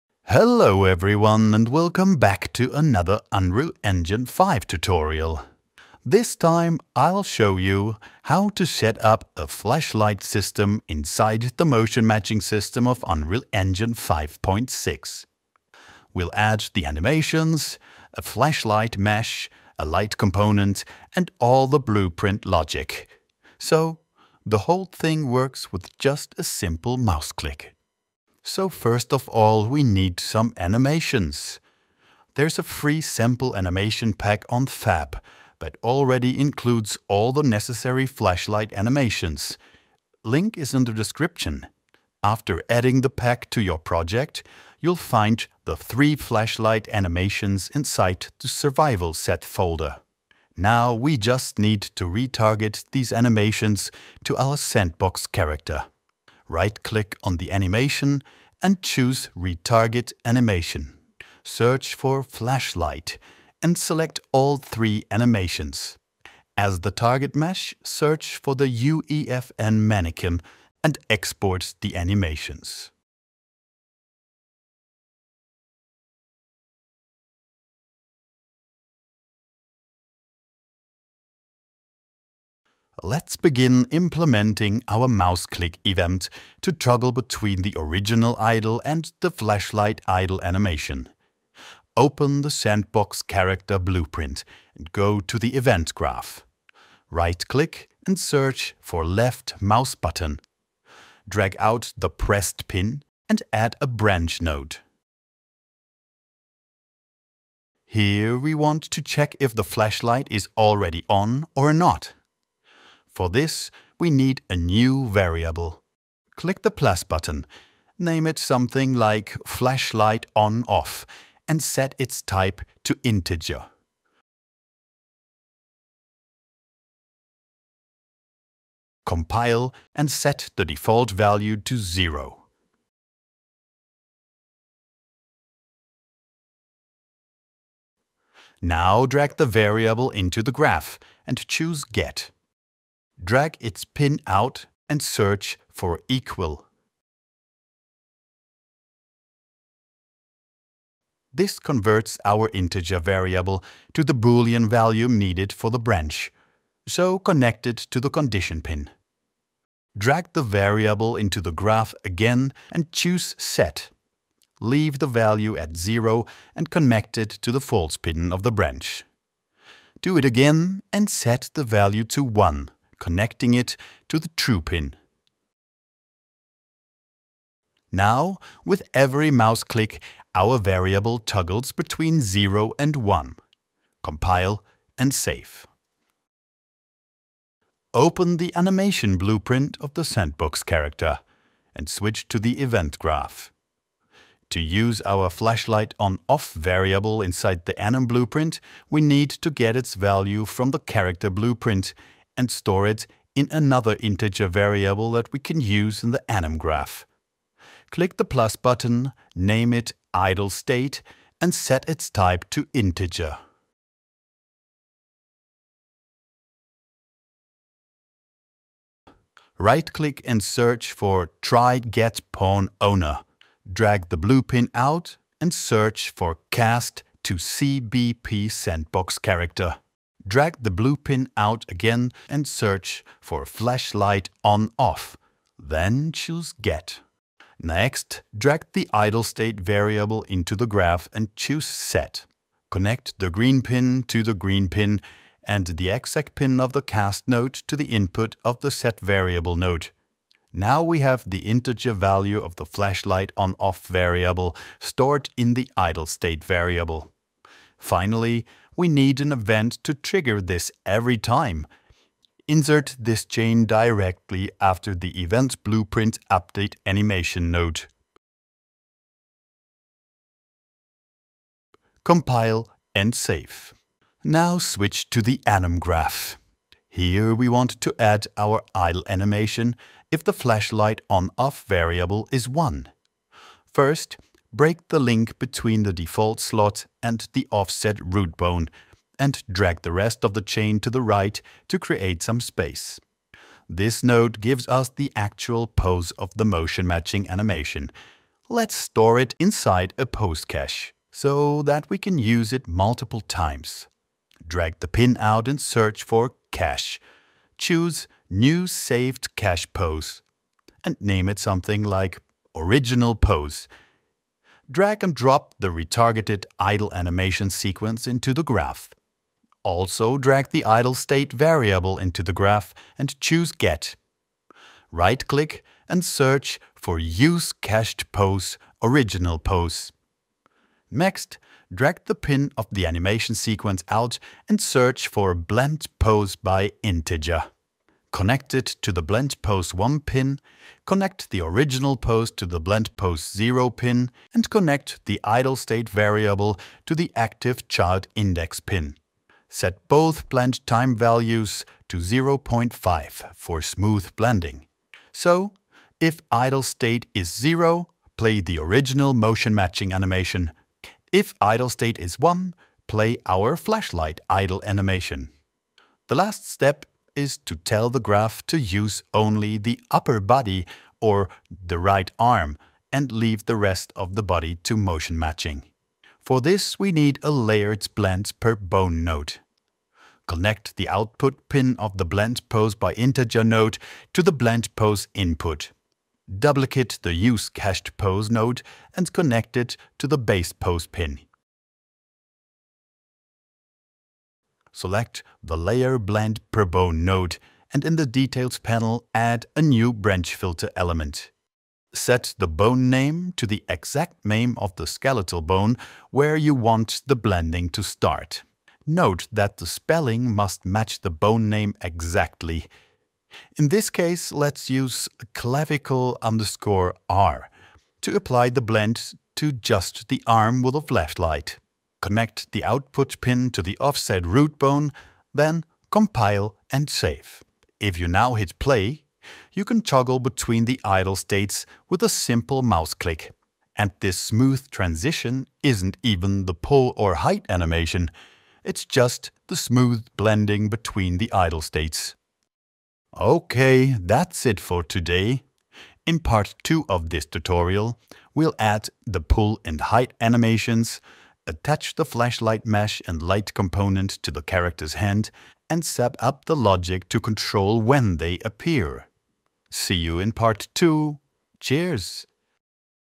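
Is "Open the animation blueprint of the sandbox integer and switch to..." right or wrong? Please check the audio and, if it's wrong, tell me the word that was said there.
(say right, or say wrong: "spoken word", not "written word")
wrong: "character", not "integer".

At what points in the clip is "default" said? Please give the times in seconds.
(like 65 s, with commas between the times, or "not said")
130 s, 285 s.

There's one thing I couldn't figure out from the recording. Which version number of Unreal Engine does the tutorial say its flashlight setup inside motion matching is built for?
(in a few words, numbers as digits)
5.6.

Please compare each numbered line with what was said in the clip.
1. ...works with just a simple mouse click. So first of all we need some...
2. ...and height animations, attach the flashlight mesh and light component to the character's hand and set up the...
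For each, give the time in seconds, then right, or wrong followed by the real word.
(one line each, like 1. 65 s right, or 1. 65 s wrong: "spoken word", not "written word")
1. 25 s right
2. 449 s right.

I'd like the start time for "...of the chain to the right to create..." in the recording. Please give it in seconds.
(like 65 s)
290 s.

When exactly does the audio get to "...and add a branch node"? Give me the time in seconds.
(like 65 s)
103 s.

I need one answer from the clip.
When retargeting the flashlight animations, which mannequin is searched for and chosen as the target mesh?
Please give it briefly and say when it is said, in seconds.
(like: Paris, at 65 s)
UEFN mannequin, at 68 s.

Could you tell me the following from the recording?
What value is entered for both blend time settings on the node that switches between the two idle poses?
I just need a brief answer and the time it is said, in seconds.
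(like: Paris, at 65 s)
0.5, at 351 s.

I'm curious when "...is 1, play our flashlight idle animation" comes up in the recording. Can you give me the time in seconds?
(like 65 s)
361 s.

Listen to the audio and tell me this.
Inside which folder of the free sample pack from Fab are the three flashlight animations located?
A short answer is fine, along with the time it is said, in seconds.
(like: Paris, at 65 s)
survival set folder, at 48 s.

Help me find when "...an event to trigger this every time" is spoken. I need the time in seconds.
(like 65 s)
259 s.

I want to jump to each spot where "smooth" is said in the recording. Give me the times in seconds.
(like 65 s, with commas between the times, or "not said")
353 s, 434 s, 439 s.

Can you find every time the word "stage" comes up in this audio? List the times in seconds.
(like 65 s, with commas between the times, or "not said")
not said.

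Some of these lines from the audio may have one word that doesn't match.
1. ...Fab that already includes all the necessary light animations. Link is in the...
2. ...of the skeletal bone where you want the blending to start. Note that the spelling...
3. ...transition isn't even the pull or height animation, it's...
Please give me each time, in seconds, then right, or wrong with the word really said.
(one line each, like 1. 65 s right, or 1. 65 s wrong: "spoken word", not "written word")
1. 34 s wrong: "flashlight", not "light"
2. 404 s right
3. 434 s right.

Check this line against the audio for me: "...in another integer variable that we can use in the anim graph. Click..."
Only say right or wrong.
right.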